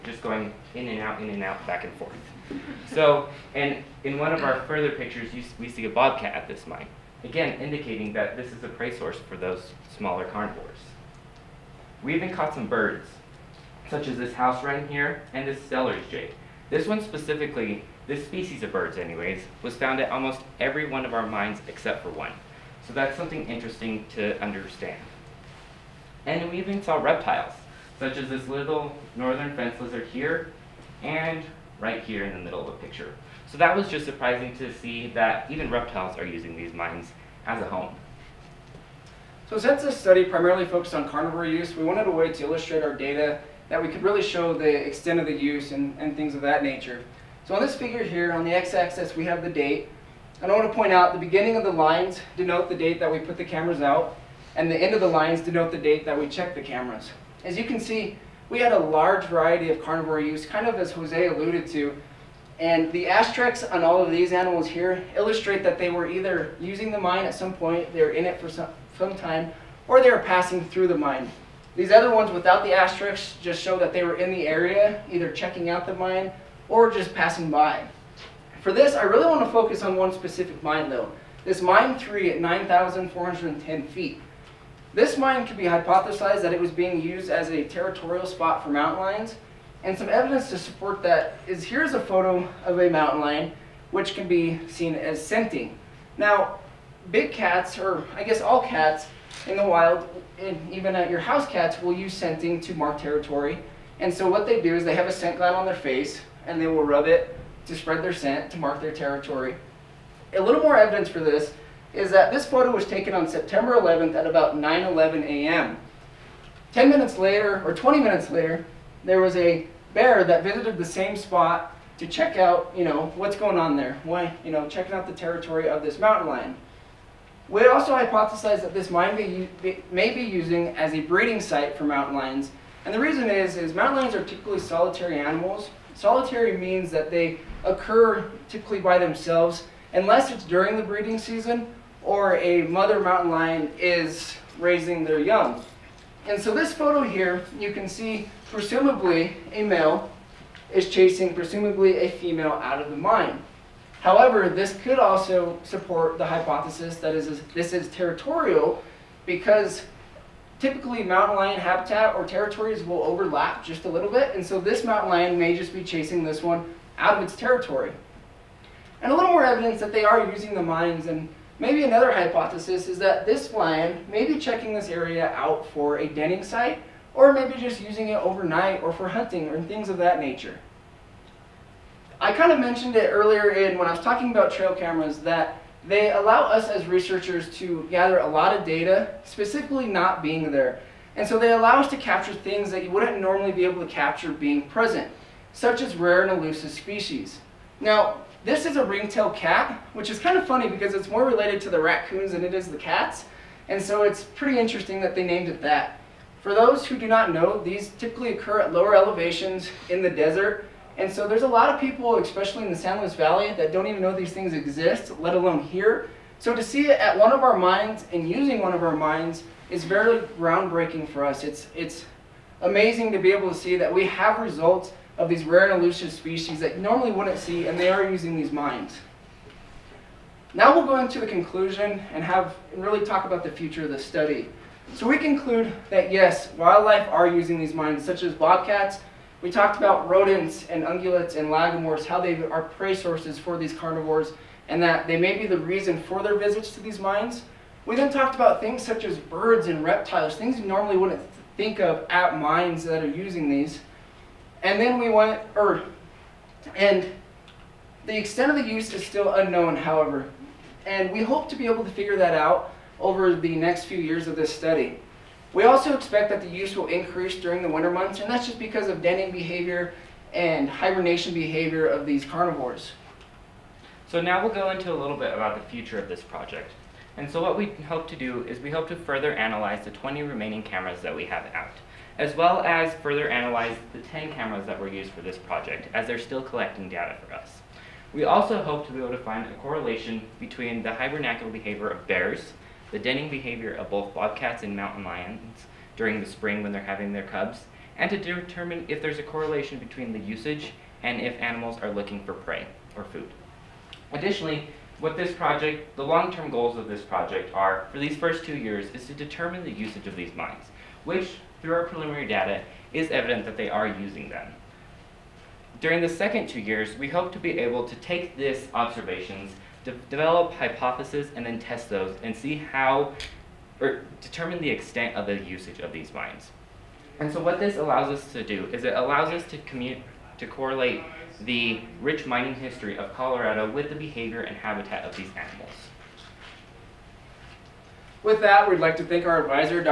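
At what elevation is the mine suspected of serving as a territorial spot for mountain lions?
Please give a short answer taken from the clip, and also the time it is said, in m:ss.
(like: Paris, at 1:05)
9,410 feet, at 1:22.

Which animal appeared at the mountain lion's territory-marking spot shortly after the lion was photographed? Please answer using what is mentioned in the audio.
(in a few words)
Bear.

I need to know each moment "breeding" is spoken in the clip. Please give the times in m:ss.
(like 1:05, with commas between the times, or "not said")
2:11, 2:20.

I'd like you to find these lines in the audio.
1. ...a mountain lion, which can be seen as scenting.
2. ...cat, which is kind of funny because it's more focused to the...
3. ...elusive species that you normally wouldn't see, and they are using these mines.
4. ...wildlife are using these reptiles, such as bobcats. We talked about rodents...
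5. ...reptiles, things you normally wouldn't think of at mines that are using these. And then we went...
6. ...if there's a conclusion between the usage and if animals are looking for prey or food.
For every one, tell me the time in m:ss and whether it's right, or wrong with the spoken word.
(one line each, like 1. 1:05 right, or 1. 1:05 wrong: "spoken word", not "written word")
1. 1:32 right
2. 3:19 wrong: "related", not "focused"
3. 3:45 right
4. 3:56 wrong: "mines", not "reptiles"
5. 4:09 right
6. 4:58 wrong: "correlation", not "conclusion".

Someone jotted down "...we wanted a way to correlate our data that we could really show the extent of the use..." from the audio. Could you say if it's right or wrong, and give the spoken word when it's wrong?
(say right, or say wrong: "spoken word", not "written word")
wrong: "illustrate", not "correlate".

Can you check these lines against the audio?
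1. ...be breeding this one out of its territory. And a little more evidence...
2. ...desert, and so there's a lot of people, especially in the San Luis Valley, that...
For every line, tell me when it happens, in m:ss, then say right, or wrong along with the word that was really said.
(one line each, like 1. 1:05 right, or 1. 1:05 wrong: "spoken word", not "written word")
1. 2:45 wrong: "chasing", not "breeding"
2. 3:30 right.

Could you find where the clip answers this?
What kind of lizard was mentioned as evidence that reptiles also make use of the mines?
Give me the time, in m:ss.
0:29.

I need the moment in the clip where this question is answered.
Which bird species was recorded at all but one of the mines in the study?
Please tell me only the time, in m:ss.
0:15.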